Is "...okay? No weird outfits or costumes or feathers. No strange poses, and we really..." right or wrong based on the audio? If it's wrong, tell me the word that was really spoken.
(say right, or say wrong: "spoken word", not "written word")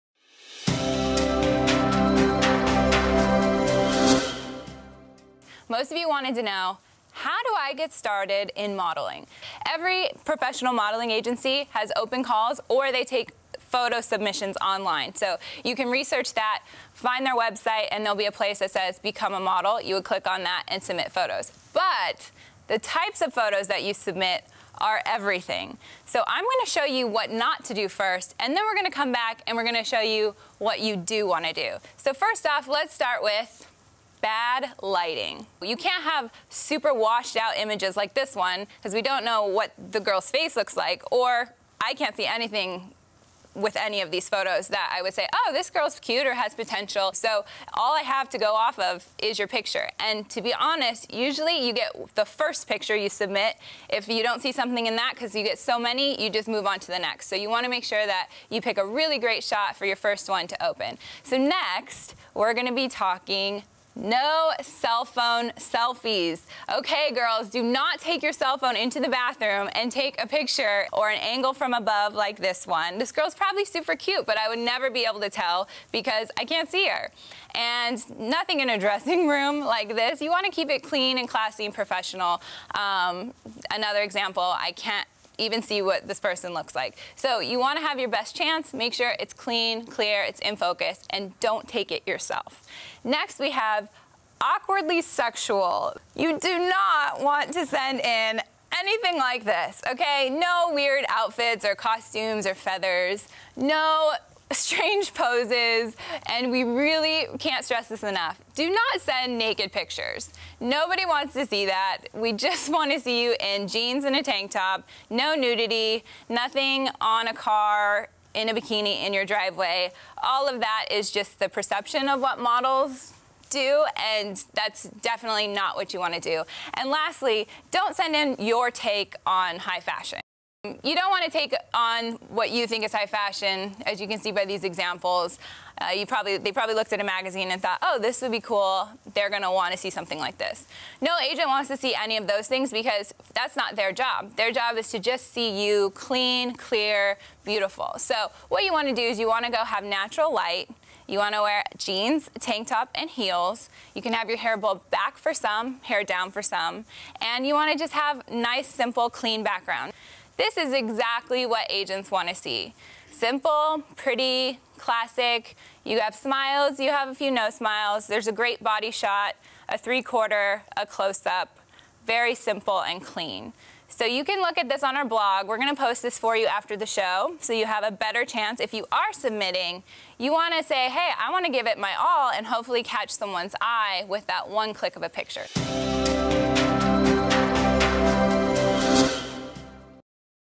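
right.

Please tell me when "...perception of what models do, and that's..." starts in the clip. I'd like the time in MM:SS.
02:01.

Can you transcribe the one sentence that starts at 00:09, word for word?
Every professional modeling agency has open calls or they take photo submissions online.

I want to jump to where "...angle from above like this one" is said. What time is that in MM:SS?
01:11.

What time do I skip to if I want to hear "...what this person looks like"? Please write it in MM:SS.
01:25.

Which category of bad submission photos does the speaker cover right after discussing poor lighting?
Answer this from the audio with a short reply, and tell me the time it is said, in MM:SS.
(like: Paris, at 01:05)
cell phone selfies, at 01:04.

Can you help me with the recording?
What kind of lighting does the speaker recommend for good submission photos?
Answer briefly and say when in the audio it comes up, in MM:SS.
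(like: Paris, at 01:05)
natural light, at 02:29.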